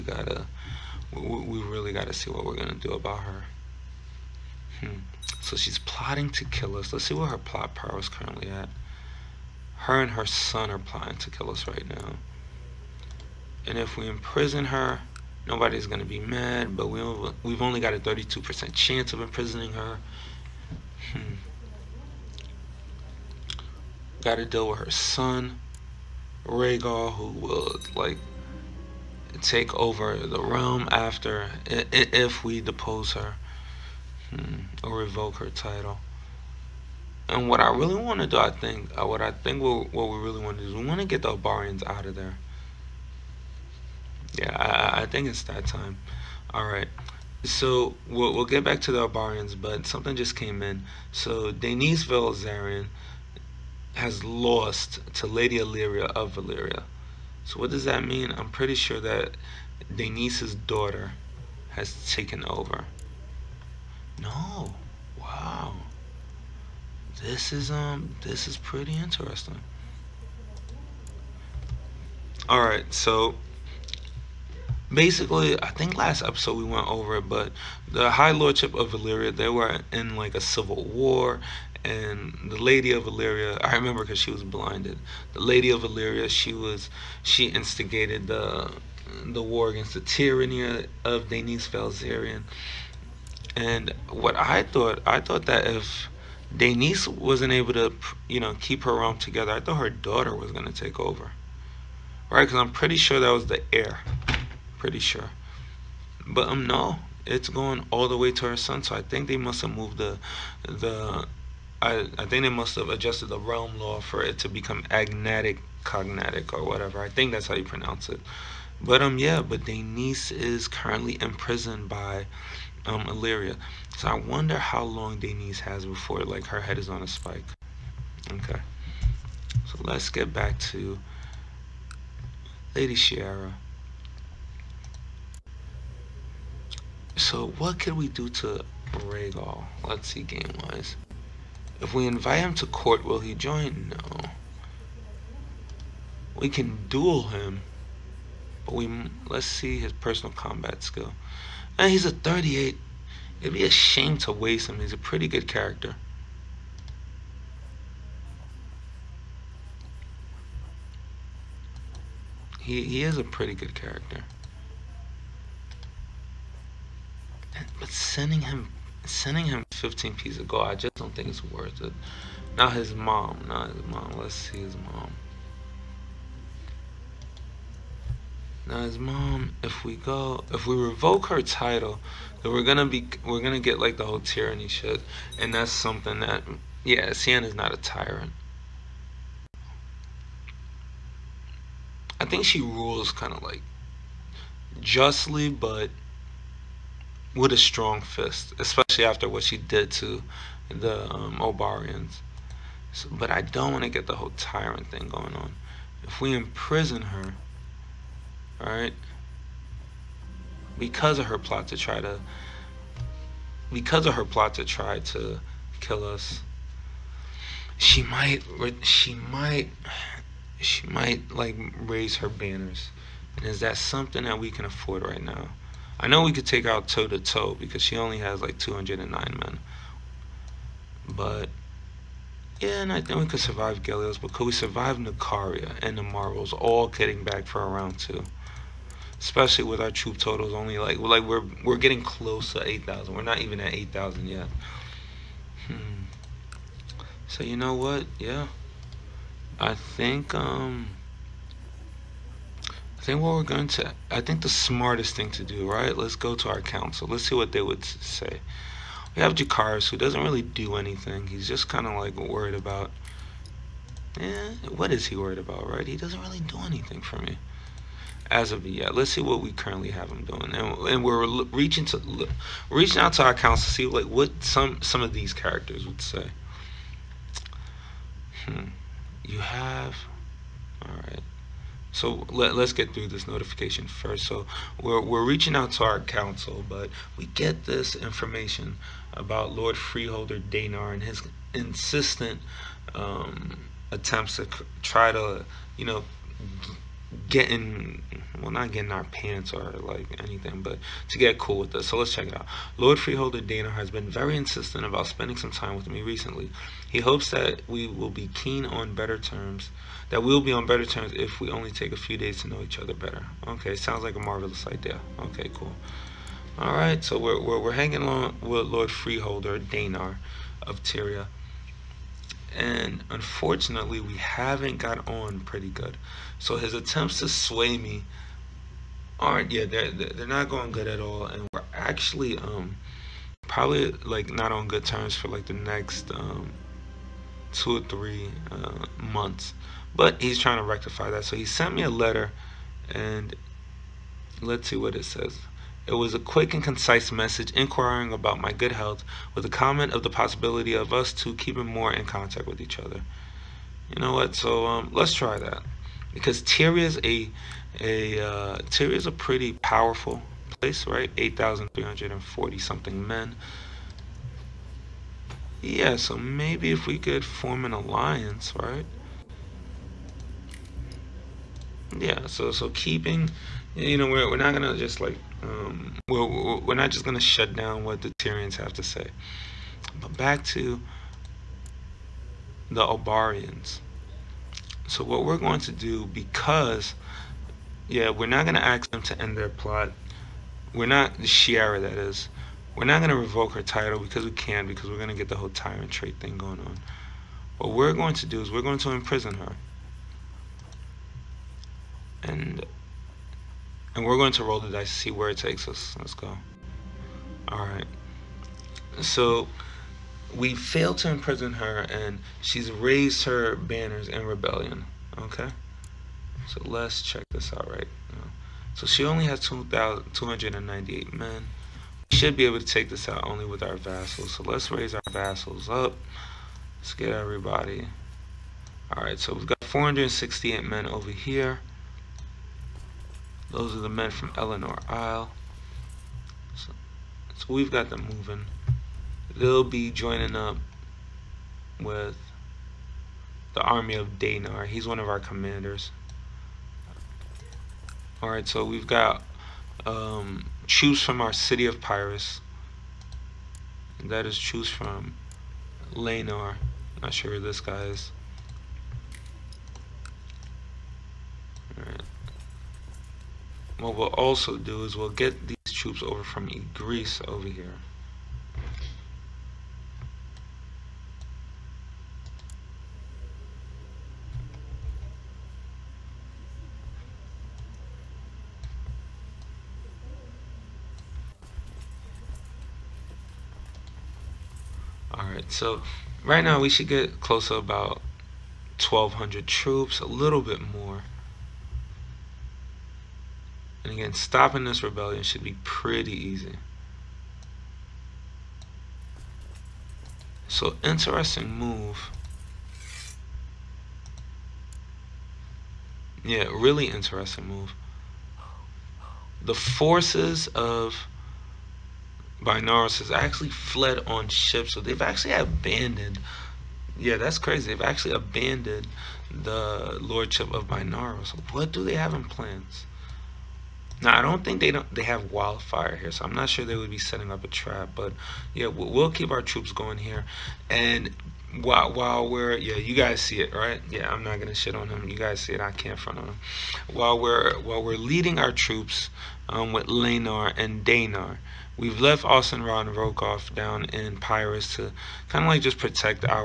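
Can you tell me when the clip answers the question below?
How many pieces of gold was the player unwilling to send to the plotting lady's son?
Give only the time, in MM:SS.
02:49.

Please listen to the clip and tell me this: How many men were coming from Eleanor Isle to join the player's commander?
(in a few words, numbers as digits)
468.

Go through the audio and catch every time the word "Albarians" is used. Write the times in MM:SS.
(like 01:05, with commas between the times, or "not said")
00:41, 00:49.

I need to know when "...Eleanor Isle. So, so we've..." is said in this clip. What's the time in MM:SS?
07:14.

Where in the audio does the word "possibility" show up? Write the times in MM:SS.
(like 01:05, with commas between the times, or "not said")
05:50.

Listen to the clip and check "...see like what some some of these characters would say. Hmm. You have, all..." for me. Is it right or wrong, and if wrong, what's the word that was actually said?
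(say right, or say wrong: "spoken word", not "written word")
right.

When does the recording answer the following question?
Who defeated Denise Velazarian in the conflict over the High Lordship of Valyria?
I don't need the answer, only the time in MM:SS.
00:55.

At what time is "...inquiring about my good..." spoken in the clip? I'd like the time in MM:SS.
05:47.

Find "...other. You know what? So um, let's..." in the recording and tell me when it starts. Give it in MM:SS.
05:52.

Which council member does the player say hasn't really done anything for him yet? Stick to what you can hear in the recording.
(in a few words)
Jakaris.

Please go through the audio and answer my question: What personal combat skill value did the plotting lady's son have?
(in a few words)
38.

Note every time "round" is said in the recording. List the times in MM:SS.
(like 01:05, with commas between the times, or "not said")
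03:57.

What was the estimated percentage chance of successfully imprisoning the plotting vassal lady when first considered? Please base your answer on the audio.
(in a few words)
32%.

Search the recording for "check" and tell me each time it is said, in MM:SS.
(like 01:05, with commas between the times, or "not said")
05:02, 06:57.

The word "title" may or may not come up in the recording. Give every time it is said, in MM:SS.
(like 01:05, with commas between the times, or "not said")
00:35, 03:01, 06:33.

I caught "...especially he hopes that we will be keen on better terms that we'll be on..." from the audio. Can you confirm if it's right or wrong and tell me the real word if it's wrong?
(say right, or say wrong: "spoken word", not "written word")
wrong: "recently", not "especially".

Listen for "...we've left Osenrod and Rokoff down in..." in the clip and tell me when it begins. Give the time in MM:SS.
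09:01.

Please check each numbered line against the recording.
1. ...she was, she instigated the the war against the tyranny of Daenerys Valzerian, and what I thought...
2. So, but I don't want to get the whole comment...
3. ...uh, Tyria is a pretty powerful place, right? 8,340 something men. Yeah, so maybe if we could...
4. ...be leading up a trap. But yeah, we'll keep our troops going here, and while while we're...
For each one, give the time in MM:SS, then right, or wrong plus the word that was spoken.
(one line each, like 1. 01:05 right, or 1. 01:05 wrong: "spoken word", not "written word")
1. 01:26 right
2. 03:22 wrong: "tyrant", not "comment"
3. 05:58 right
4. 08:46 wrong: "setting", not "leading".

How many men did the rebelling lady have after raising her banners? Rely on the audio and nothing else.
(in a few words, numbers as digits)
2,298.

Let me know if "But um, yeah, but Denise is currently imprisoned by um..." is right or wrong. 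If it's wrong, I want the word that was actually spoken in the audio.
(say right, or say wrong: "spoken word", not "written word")
right.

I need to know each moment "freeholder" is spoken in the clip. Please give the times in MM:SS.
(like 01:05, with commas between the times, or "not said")
04:49, 05:02, 05:18.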